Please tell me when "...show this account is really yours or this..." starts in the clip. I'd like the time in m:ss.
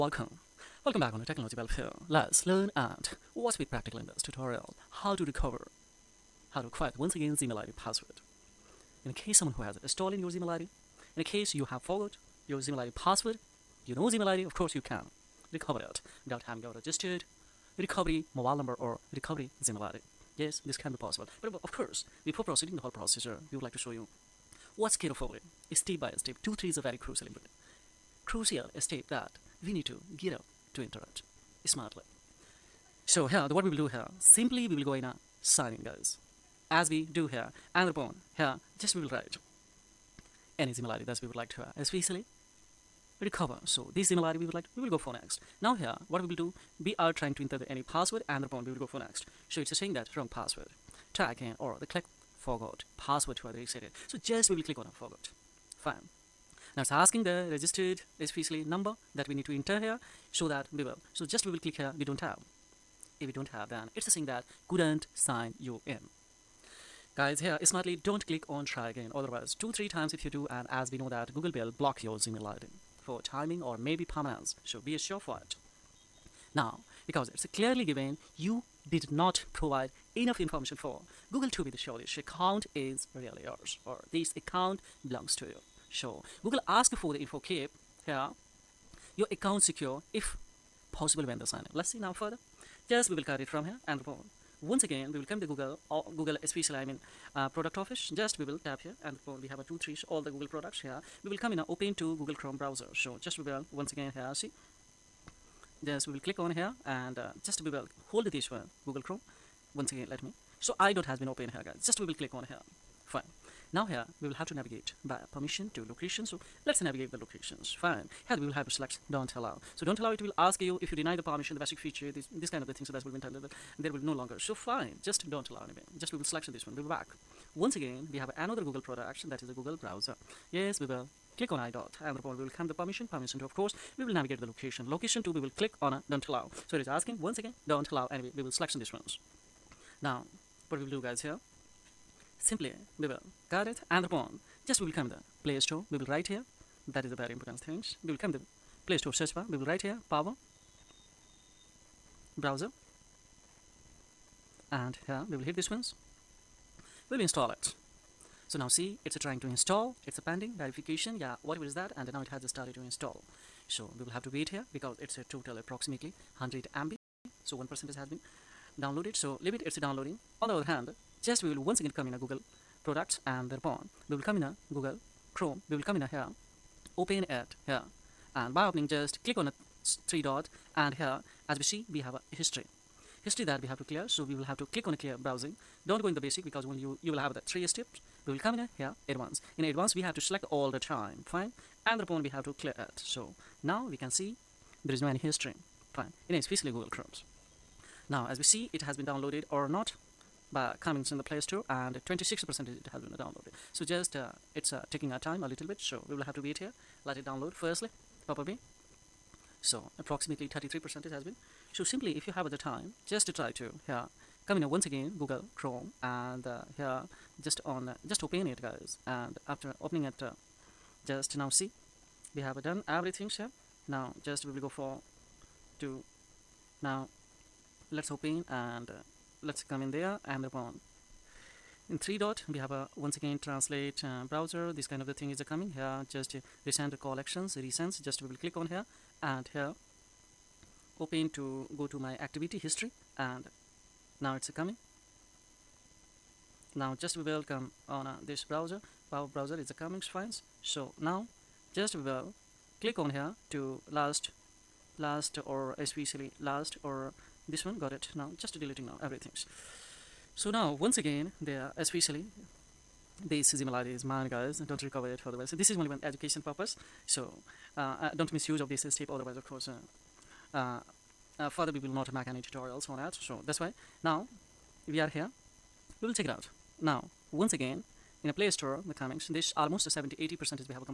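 1:21.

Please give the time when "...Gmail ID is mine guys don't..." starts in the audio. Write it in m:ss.
4:23.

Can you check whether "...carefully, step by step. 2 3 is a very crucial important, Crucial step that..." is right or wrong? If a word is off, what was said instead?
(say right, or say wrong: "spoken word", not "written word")
right.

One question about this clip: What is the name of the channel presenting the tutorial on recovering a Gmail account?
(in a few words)
Technology Bulb.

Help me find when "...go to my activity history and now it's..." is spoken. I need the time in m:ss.
4:01.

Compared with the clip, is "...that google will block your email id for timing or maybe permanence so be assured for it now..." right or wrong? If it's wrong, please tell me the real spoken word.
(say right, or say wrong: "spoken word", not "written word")
right.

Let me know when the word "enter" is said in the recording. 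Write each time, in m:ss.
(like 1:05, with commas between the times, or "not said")
0:47, 0:59.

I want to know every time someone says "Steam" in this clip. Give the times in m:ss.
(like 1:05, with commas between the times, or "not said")
not said.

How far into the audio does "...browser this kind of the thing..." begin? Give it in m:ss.
3:54.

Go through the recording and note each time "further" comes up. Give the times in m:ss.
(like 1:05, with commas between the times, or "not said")
1:32, 4:31.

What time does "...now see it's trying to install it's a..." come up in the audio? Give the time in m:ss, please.
2:38.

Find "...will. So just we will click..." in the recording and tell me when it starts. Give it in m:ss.
1:00.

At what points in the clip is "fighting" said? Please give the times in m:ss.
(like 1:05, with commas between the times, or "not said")
not said.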